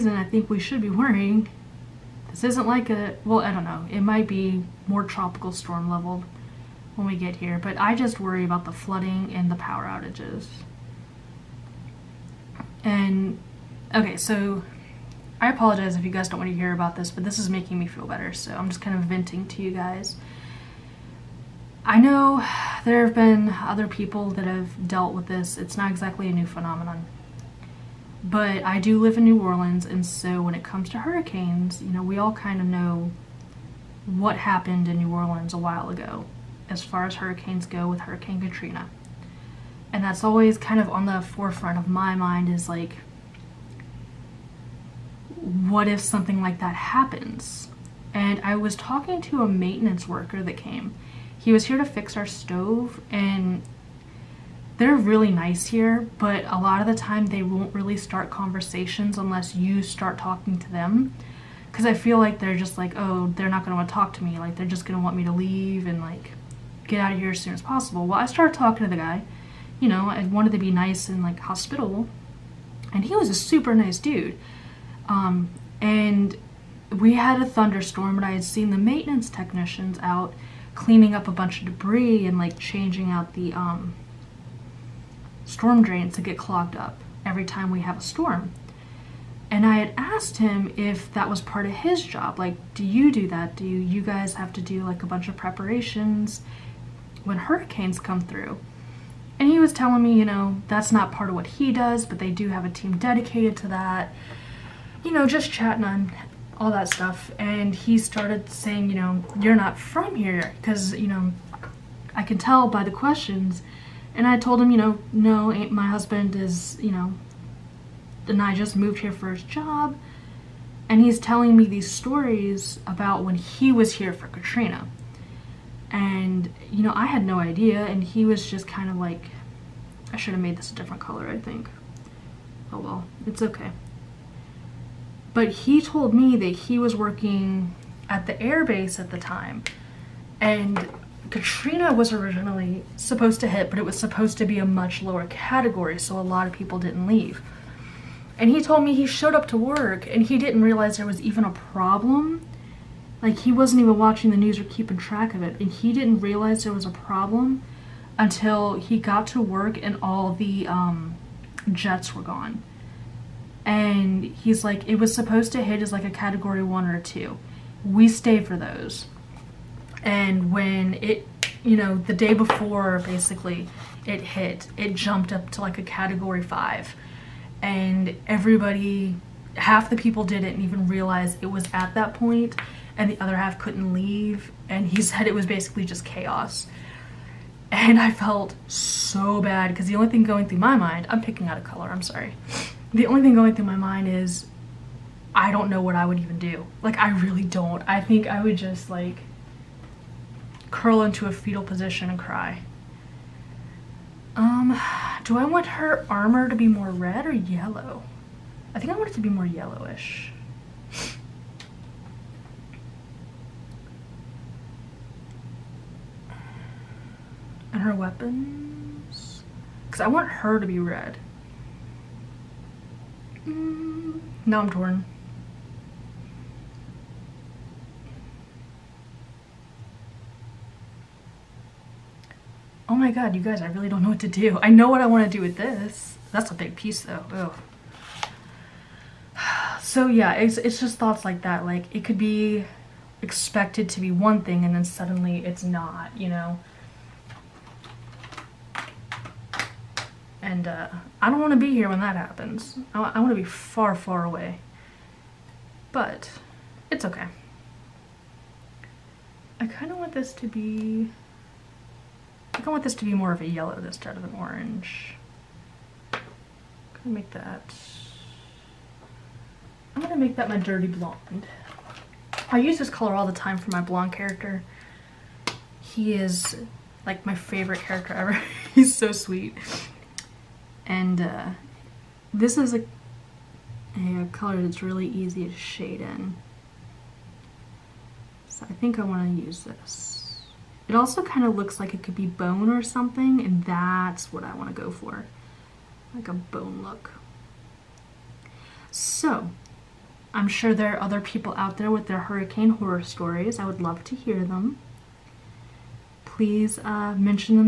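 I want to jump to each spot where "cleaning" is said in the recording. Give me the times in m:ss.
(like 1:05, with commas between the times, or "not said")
1:20.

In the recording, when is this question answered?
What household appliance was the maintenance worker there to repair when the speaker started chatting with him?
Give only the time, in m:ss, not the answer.
0:52.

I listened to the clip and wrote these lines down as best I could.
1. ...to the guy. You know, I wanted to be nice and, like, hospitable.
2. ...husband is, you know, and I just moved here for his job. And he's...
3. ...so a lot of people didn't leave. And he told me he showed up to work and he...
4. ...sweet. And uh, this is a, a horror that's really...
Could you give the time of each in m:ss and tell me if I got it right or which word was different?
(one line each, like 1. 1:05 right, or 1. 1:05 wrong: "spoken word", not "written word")
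1. 1:08 right
2. 1:55 right
3. 2:25 right
4. 4:39 wrong: "color", not "horror".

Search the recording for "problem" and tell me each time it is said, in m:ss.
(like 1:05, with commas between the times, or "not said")
2:31, 2:36.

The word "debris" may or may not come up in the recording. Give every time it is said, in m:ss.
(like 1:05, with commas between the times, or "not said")
1:21.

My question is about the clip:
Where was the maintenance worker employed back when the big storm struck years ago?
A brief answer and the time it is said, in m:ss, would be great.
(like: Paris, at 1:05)
the airbase, at 2:18.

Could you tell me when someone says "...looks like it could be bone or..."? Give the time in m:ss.
4:51.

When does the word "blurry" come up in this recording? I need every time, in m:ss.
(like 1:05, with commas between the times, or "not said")
not said.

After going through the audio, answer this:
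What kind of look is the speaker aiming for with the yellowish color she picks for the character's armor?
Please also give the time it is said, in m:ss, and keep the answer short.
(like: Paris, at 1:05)
bone look, at 4:56.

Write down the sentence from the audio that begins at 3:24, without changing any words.
Um, do I want her armor to be more red or yellow?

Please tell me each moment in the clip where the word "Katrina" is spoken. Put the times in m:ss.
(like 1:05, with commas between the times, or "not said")
0:38, 2:04, 2:21.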